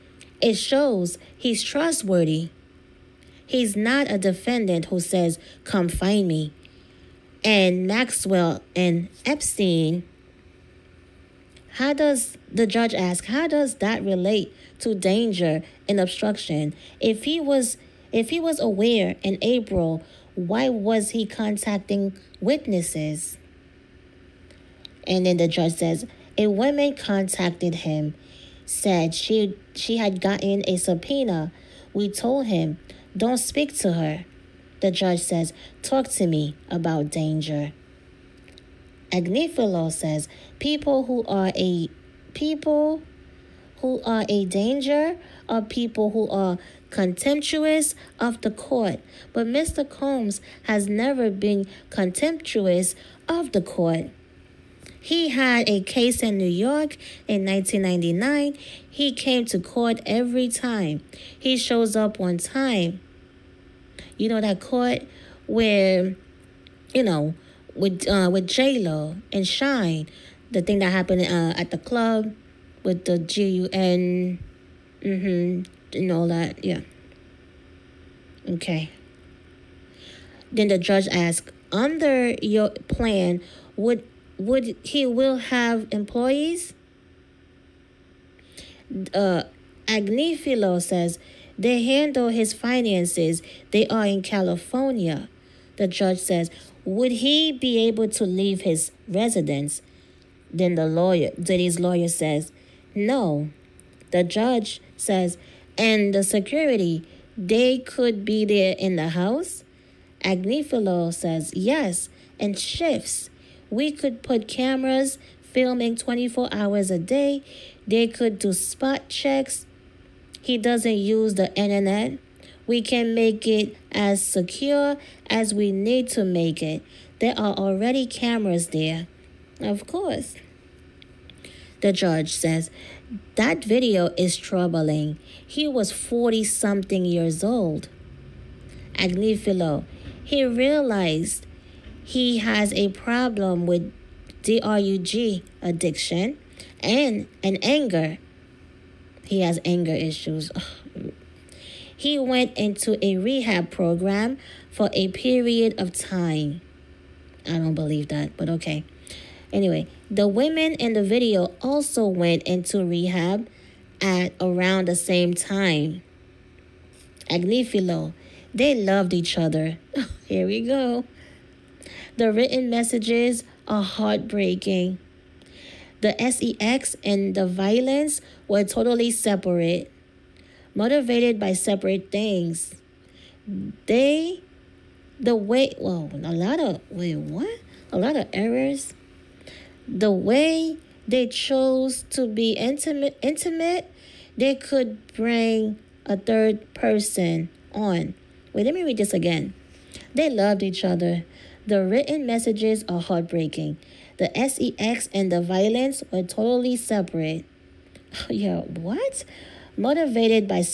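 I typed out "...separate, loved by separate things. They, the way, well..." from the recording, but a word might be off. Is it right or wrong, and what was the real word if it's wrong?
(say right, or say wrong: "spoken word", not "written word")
wrong: "motivated", not "loved".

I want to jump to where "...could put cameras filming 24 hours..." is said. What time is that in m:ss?
1:53.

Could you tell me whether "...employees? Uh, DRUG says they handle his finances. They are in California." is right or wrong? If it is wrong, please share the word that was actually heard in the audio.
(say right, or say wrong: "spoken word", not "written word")
wrong: "Agnifilo", not "DRUG".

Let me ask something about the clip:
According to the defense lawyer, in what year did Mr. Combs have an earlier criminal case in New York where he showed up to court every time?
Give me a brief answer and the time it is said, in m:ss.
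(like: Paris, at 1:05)
1999, at 0:57.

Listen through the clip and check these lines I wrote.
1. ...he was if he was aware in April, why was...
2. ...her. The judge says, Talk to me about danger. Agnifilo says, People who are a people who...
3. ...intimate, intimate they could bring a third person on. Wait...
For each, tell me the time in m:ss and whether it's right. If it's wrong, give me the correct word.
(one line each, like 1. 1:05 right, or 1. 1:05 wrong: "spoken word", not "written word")
1. 0:17 right
2. 0:33 right
3. 3:12 right.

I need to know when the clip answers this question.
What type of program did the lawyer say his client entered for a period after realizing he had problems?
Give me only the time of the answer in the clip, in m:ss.
2:33.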